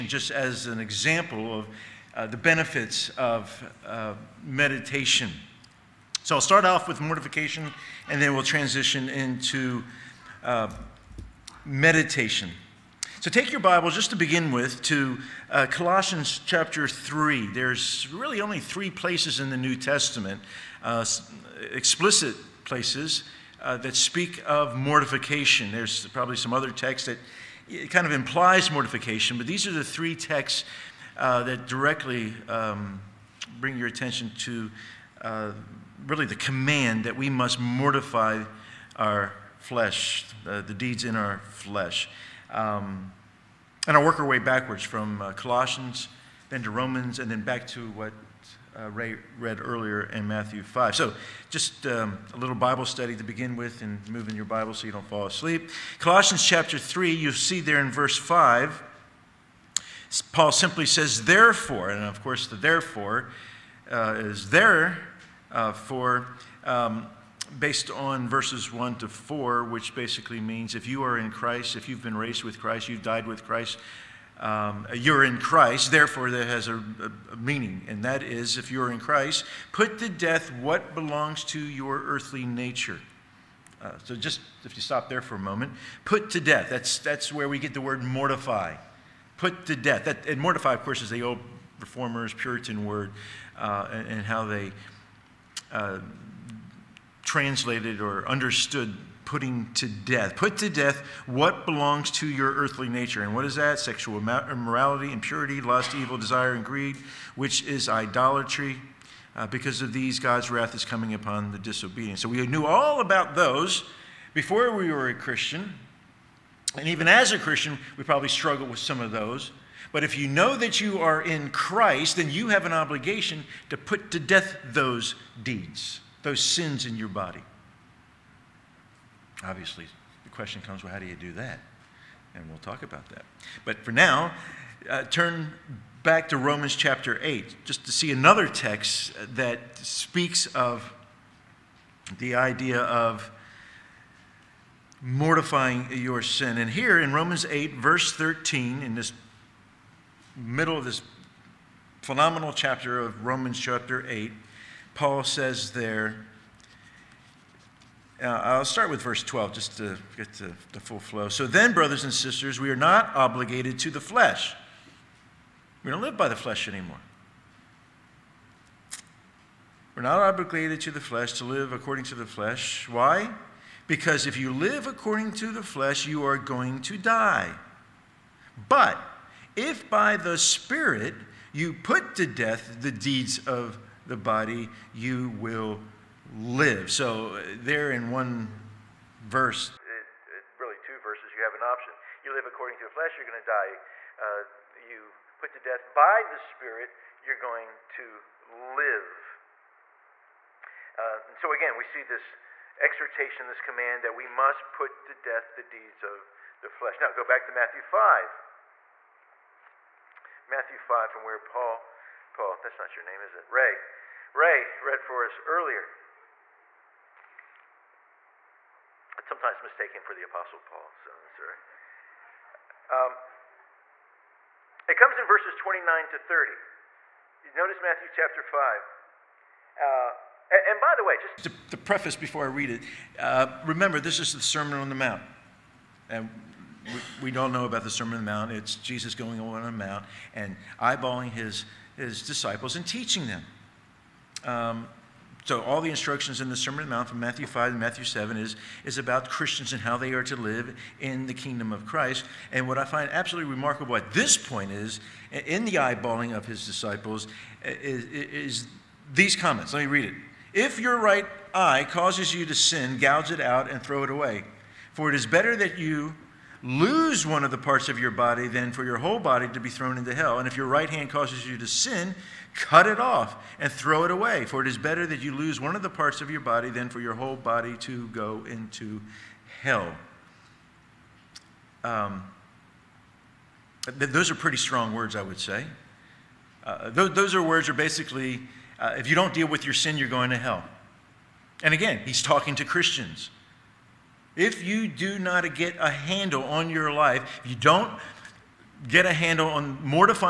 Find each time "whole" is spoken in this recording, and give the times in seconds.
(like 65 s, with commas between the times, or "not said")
268 s, 277 s.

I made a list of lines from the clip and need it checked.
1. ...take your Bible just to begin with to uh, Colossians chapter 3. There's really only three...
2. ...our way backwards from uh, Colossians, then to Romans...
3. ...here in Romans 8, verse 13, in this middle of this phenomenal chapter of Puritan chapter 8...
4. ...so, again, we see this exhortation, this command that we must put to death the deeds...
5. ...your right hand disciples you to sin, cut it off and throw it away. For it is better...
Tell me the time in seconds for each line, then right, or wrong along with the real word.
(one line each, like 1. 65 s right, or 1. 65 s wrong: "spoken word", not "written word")
1. 13 s right
2. 44 s right
3. 146 s wrong: "Romans", not "Puritan"
4. 201 s right
5. 270 s wrong: "causes", not "disciples".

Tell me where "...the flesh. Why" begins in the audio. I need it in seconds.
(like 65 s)
172 s.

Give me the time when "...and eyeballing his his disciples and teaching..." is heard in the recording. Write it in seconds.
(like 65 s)
240 s.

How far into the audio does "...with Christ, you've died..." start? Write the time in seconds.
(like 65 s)
72 s.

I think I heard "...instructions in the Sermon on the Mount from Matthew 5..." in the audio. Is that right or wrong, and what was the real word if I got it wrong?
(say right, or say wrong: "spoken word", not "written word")
right.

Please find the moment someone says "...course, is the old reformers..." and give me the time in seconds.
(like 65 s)
90 s.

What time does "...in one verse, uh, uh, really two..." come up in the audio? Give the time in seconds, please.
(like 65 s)
187 s.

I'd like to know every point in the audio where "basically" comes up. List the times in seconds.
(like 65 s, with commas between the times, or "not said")
69 s, 287 s.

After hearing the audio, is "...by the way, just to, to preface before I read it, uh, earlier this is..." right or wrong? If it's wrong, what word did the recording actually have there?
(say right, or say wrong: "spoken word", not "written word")
wrong: "remember", not "earlier".